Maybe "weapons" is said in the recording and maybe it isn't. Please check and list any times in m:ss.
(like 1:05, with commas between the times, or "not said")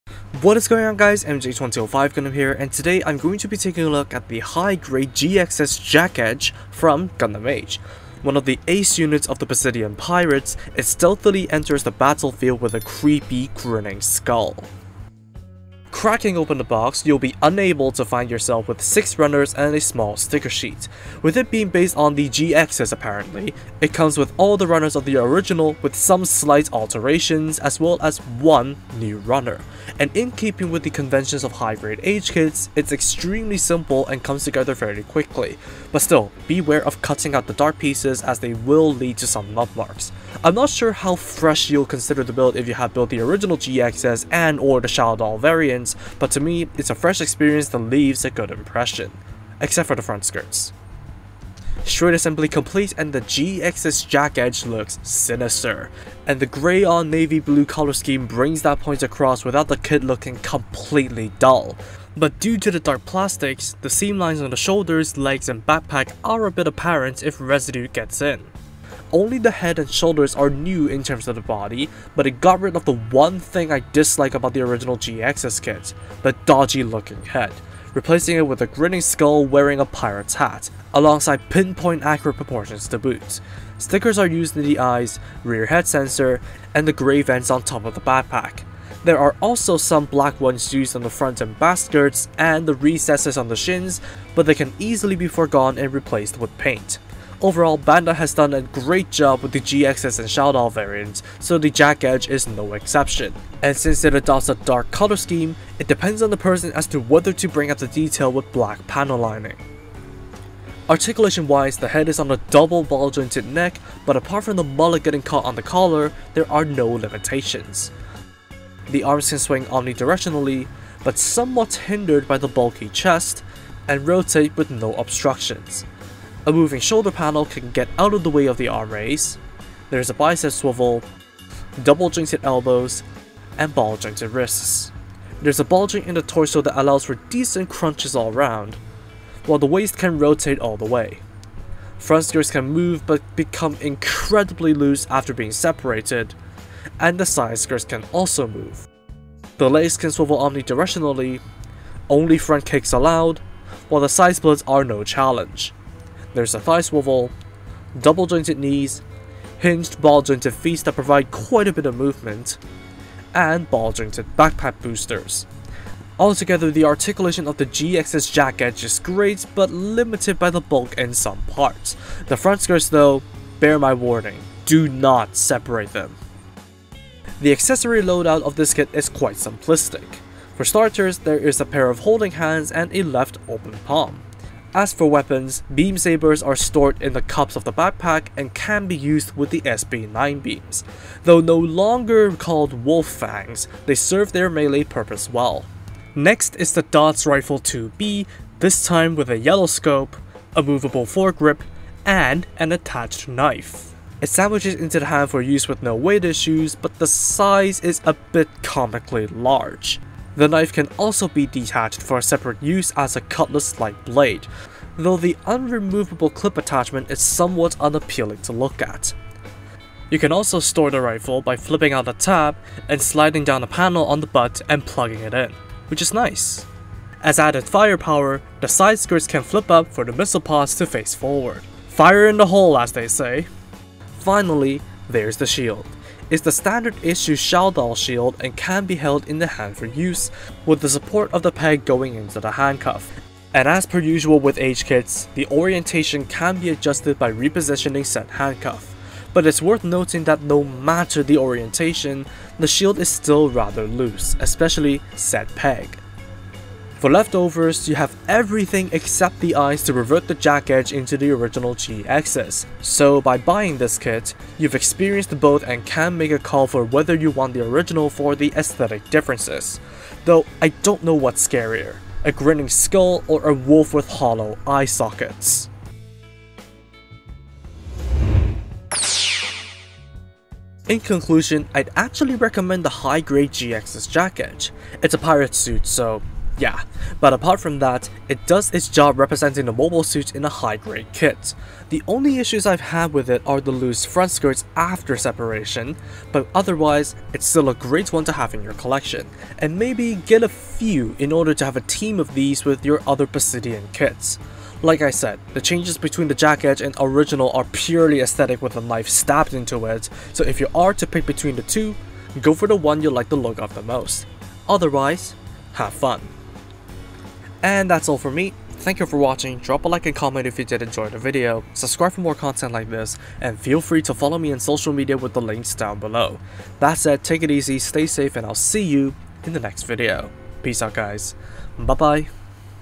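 3:05.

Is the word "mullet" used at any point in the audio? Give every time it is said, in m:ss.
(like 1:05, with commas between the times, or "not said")
1:54.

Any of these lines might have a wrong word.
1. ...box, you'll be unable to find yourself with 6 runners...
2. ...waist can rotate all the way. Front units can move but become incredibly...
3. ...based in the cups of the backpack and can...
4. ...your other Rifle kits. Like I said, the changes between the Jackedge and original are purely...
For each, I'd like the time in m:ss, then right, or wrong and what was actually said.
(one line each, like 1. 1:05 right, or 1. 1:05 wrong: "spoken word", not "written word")
1. 0:16 right
2. 2:19 wrong: "skirts", not "units"
3. 3:06 wrong: "stored", not "based"
4. 5:02 wrong: "Bisidian", not "Rifle".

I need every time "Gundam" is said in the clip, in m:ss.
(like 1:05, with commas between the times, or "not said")
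0:02, 0:07.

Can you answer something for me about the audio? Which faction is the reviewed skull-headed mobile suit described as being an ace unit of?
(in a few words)
Bisidian Pirates.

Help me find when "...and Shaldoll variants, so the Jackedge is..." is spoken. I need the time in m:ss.
1:40.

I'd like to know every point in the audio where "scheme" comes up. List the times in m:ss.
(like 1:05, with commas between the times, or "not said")
0:57, 1:45.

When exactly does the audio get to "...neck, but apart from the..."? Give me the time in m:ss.
1:53.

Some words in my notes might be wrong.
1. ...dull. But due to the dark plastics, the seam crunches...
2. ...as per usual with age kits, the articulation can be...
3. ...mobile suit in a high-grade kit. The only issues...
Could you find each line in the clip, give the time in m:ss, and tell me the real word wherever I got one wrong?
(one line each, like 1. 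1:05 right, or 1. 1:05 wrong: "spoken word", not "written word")
1. 1:01 wrong: "lines", not "crunches"
2. 4:03 wrong: "orientation", not "articulation"
3. 4:49 right.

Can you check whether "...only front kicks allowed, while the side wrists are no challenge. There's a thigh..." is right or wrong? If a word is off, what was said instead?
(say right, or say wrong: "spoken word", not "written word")
wrong: "splits", not "wrists".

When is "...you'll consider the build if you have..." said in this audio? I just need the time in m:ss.
0:41.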